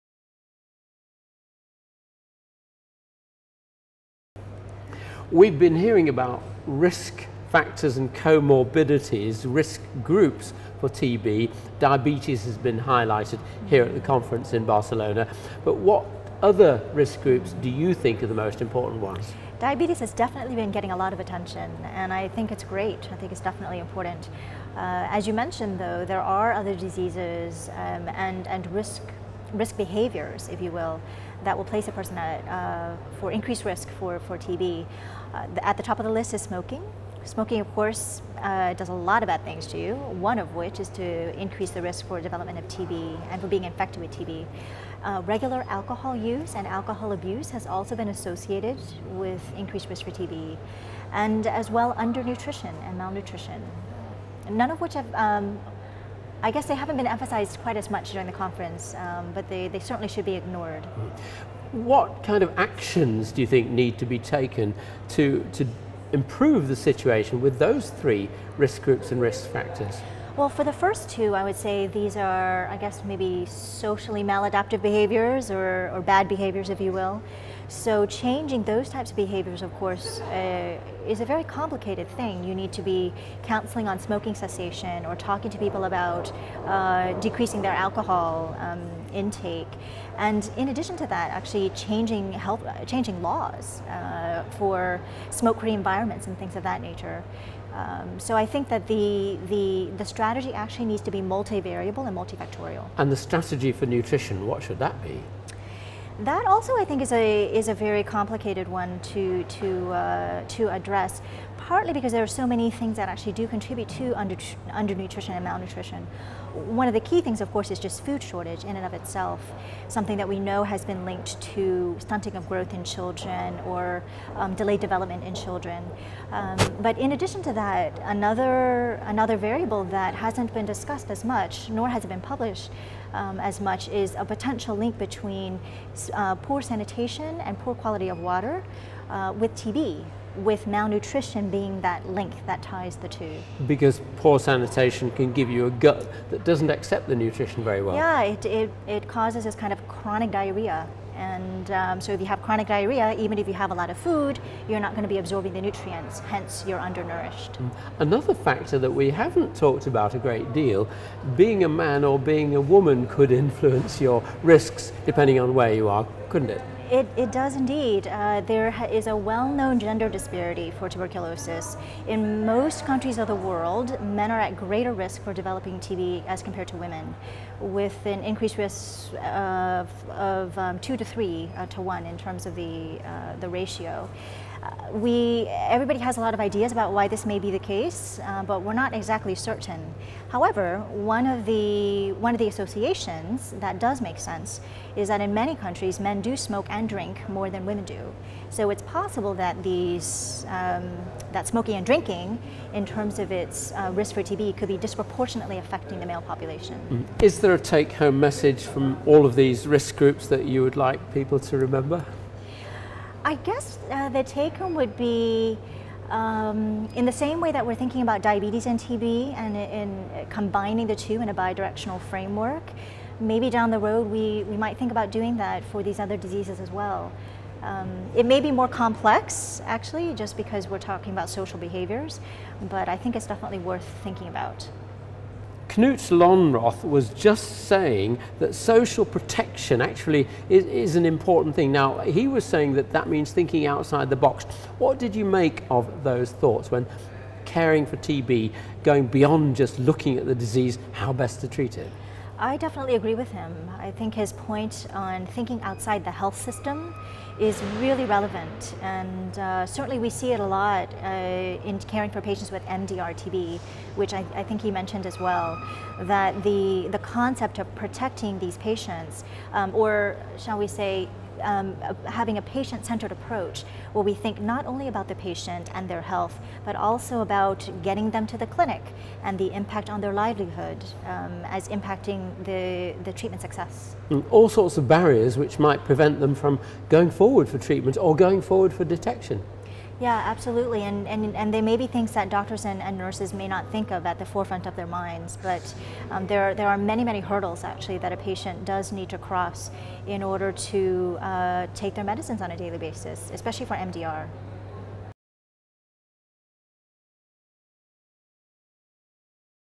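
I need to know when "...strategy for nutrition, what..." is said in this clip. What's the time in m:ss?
1:43.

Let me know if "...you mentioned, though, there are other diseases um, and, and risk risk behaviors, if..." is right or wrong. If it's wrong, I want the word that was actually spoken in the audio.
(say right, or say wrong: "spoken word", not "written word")
right.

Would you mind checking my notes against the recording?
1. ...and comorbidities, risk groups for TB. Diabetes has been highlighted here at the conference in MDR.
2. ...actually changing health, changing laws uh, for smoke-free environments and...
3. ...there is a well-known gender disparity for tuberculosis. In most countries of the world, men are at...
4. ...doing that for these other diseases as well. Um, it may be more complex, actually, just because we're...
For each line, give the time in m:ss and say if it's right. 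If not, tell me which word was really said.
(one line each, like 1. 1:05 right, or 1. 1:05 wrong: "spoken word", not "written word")
1. 0:07 wrong: "Barcelona", not "MDR"
2. 1:31 right
3. 2:48 right
4. 3:45 right.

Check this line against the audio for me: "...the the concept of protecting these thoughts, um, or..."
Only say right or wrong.
wrong.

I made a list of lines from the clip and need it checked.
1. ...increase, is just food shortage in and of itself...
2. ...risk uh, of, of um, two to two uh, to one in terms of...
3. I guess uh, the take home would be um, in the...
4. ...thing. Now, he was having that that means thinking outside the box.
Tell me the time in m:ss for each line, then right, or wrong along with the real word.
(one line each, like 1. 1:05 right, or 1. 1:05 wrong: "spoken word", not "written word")
1. 1:57 wrong: "course", not "increase"
2. 2:58 wrong: "three", not "two"
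3. 3:33 right
4. 4:01 wrong: "saying", not "having".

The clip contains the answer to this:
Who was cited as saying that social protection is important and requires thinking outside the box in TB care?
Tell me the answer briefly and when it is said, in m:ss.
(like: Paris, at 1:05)
Knut Lonnroth, at 3:55.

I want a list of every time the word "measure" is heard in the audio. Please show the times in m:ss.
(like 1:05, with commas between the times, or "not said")
not said.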